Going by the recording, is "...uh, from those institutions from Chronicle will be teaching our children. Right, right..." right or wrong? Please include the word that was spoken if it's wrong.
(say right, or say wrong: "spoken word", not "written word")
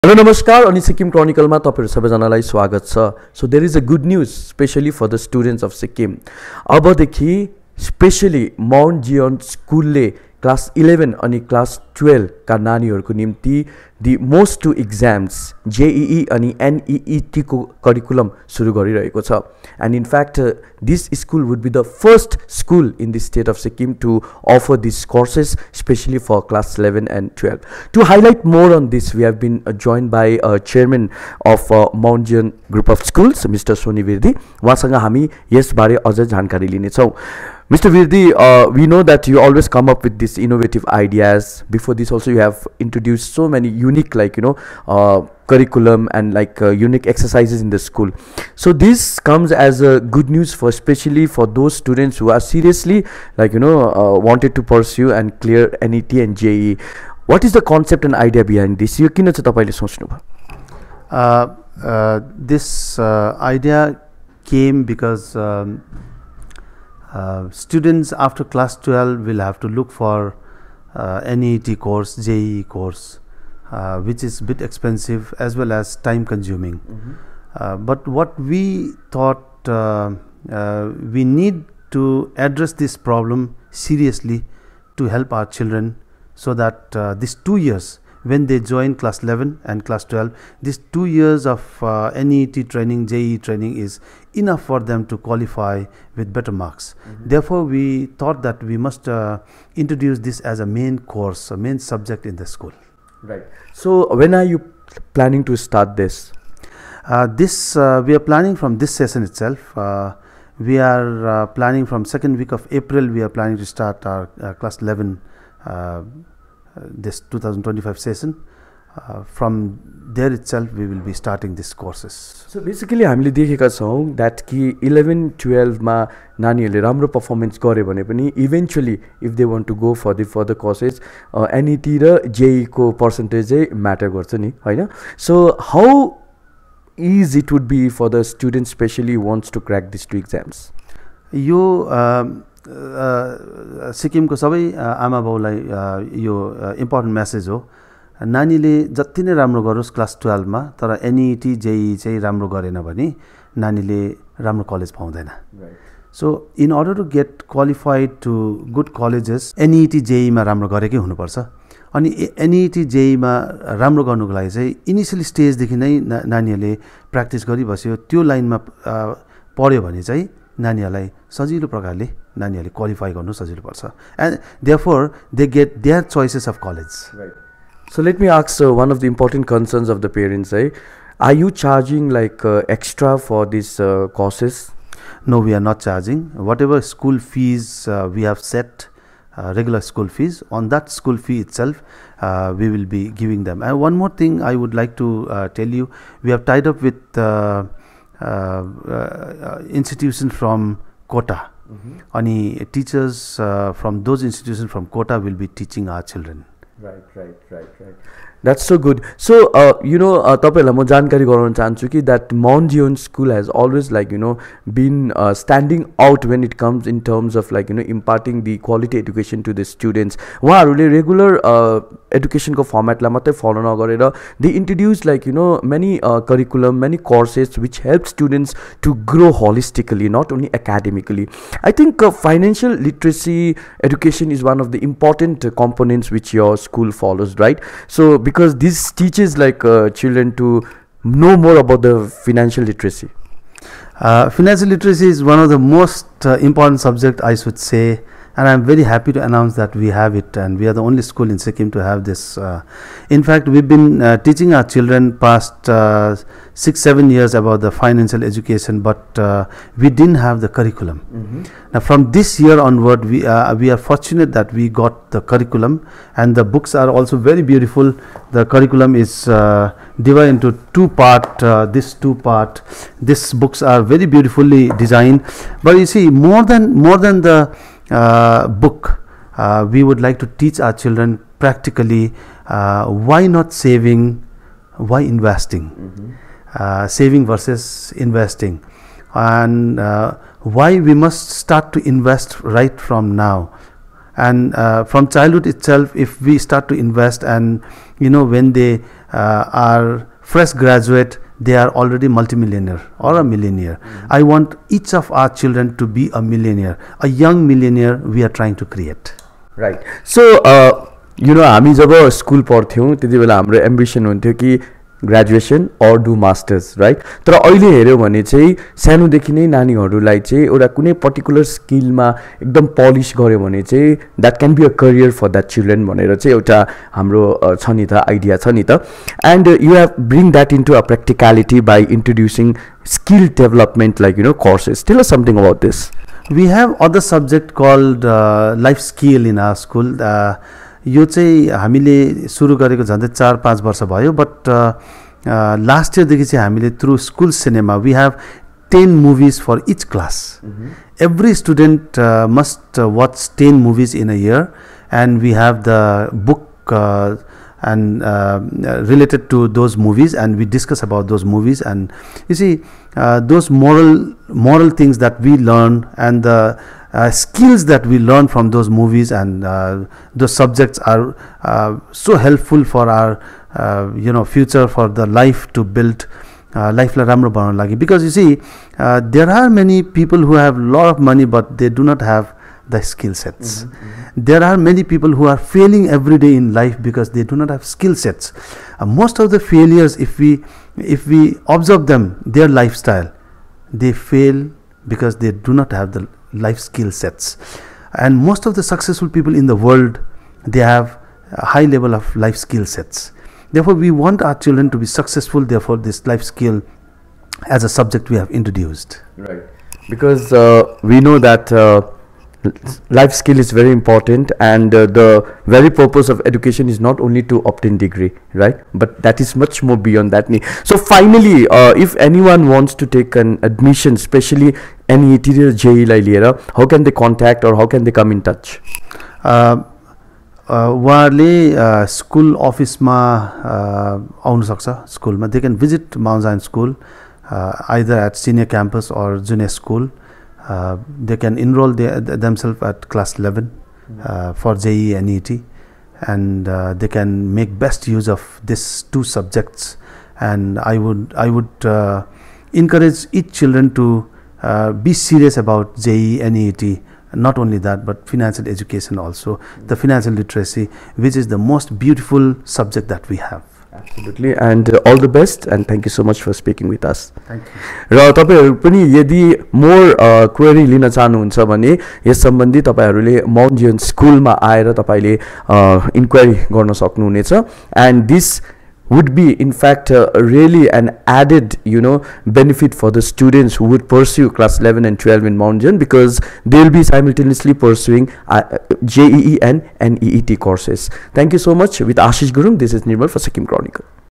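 wrong: "Kota", not "Chronicle".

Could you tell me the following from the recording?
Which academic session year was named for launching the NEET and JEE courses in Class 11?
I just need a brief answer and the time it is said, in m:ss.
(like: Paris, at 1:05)
2025, at 1:57.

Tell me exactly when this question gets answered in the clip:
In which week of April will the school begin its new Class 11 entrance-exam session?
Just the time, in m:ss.
1:52.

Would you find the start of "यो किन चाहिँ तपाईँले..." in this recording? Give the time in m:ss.
0:58.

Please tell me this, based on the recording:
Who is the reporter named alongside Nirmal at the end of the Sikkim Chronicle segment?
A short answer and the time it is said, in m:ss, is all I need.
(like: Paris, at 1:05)
Ashish Gurung, at 8:12.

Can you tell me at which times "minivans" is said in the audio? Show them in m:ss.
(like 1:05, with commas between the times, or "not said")
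not said.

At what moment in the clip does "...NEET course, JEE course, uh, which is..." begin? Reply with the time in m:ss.
1:11.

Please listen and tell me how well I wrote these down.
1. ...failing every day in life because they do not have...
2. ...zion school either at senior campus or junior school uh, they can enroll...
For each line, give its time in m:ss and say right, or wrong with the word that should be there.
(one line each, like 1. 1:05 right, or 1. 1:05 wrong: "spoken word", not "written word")
1. 6:25 right
2. 7:16 right.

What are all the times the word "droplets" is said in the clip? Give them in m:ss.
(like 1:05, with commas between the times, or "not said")
not said.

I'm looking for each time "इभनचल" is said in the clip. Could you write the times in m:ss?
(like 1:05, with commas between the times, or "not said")
2:08.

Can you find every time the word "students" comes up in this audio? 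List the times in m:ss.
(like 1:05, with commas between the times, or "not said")
0:51, 1:07, 3:39, 3:48, 8:03.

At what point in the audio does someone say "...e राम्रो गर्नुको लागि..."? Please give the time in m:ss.
2:43.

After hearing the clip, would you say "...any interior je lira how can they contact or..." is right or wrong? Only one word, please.
right.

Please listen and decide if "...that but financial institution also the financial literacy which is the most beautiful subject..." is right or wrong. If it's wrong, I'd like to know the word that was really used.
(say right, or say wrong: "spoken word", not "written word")
wrong: "education", not "institution".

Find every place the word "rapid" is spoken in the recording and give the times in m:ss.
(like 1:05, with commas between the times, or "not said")
not said.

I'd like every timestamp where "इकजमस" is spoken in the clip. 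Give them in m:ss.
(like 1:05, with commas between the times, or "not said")
0:14, 2:20.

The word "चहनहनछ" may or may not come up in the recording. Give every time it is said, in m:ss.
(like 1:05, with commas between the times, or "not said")
7:50.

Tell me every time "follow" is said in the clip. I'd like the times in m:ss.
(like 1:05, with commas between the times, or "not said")
3:43, 3:56.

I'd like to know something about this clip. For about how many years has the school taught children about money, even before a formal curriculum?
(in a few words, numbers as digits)
Six, seven years.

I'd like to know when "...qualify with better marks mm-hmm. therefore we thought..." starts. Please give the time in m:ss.
1:35.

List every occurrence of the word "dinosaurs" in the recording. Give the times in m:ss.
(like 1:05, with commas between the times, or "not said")
not said.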